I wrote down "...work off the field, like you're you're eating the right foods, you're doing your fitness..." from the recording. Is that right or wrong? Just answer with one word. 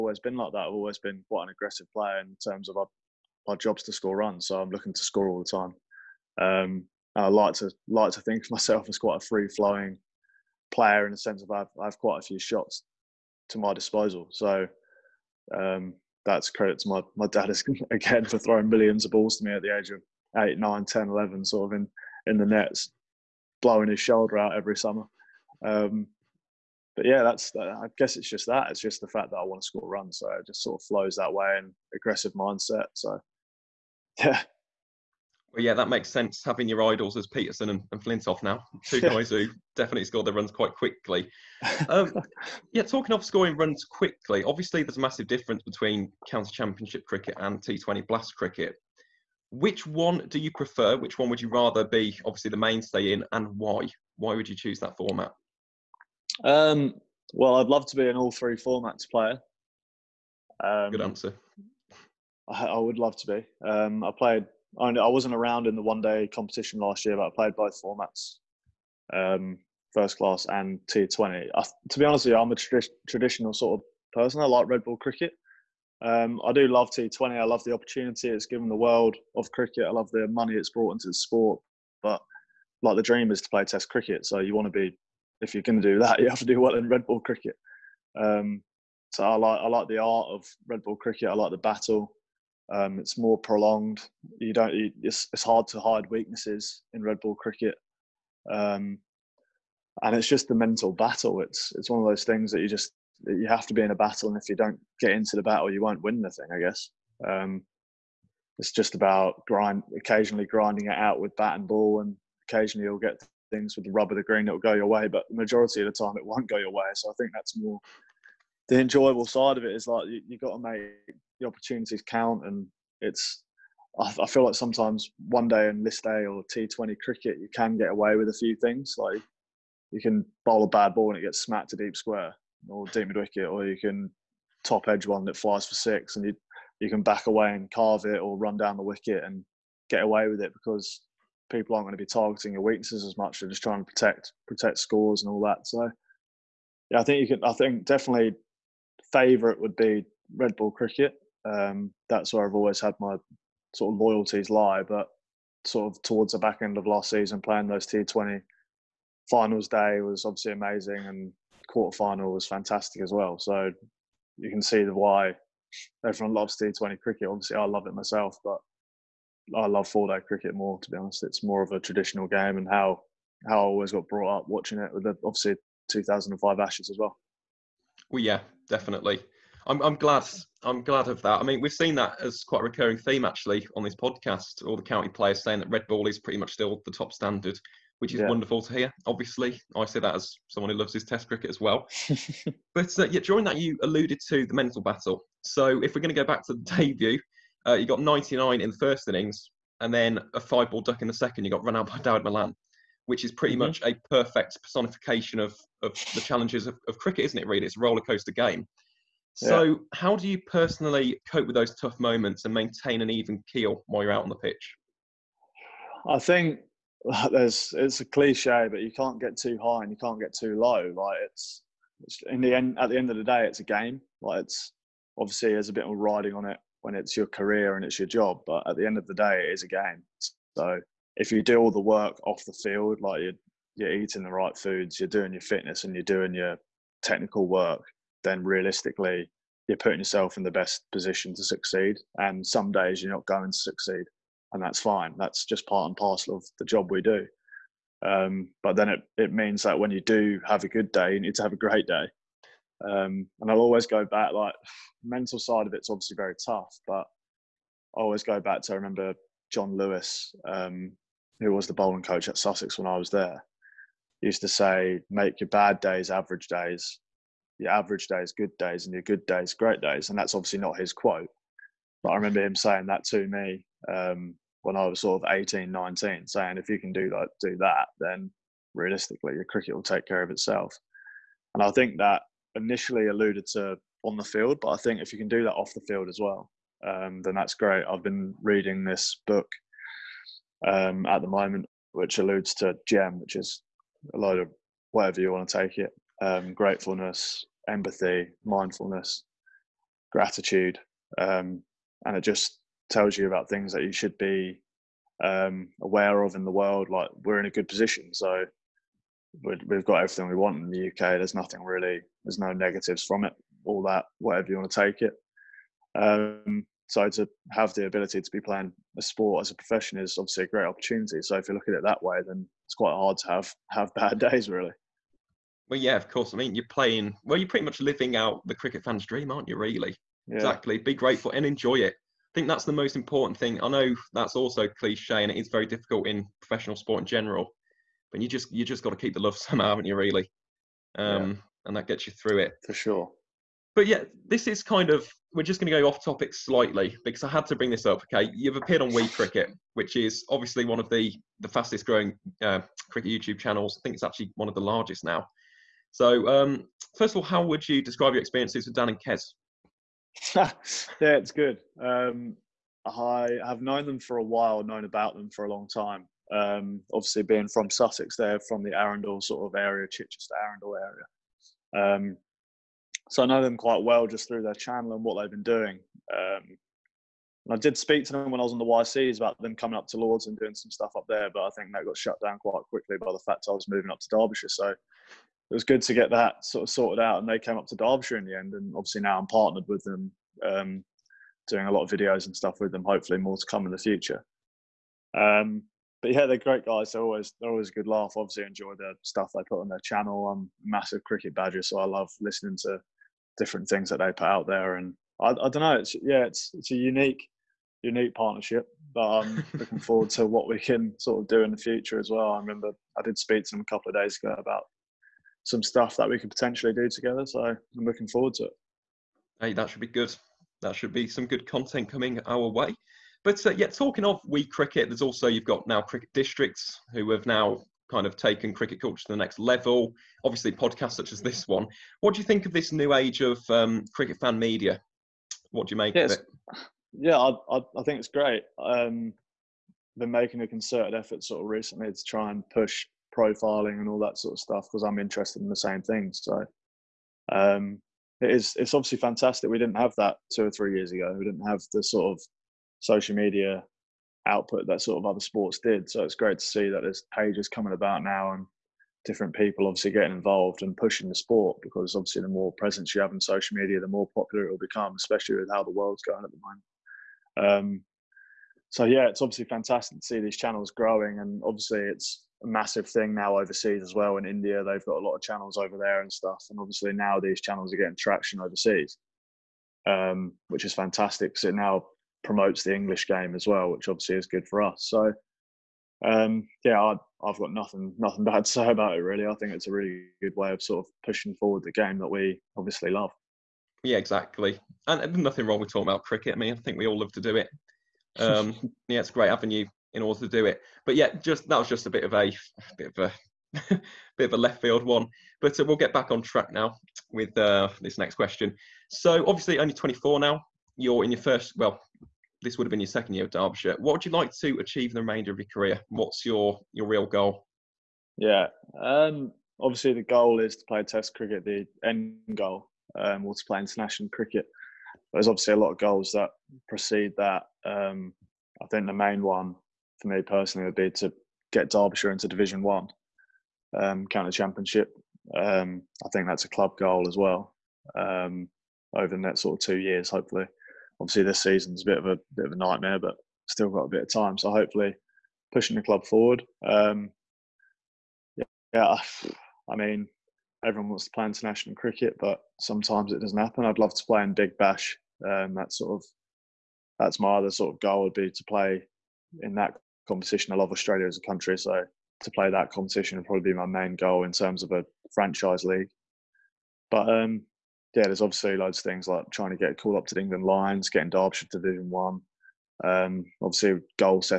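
right.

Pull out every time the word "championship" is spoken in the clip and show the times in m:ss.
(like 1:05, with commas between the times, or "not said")
0:46, 8:54.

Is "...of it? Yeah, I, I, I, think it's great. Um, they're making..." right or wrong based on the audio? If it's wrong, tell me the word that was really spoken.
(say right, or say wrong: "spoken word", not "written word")
right.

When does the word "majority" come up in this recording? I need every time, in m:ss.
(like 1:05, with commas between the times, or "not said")
1:55.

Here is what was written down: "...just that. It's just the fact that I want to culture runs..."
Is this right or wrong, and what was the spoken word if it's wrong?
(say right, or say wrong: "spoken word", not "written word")
wrong: "score", not "culture".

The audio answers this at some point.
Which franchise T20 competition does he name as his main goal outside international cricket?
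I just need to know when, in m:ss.
9:14.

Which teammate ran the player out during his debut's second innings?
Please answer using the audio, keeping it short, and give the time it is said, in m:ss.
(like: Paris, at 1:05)
Dawid Malan, at 3:21.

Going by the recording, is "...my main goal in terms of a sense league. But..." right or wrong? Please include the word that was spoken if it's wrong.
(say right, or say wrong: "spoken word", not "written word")
wrong: "franchise", not "sense".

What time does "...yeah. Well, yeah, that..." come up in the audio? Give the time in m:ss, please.
0:34.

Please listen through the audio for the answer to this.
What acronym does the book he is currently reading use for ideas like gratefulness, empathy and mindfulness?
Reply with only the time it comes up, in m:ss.
4:52.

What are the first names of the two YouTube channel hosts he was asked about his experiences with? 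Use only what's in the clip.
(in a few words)
Dan and Kes.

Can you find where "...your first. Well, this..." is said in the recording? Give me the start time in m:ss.
8:31.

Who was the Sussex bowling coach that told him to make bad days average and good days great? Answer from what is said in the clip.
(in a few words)
John Lewis.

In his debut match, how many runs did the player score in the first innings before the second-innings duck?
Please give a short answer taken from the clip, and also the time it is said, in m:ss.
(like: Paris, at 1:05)
99, at 3:18.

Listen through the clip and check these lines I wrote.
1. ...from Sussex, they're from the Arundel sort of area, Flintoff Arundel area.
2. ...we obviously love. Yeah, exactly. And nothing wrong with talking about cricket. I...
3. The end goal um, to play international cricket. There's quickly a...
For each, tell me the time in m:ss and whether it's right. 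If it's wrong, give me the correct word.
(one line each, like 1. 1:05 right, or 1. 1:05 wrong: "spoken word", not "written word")
1. 6:07 wrong: "Chichester", not "Flintoff"
2. 8:12 right
3. 8:41 wrong: "obviously", not "quickly".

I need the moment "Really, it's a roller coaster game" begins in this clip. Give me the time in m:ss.
3:27.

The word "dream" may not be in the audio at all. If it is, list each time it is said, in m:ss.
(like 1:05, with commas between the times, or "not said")
1:23, 5:29.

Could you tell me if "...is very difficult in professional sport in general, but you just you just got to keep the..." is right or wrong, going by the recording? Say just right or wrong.
right.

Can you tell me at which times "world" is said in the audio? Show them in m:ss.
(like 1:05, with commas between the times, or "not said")
1:18, 5:06, 7:45.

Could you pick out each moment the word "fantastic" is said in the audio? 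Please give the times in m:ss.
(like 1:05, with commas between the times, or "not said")
2:42, 7:28, 7:49, 8:00.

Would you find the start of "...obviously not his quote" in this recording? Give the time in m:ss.
4:30.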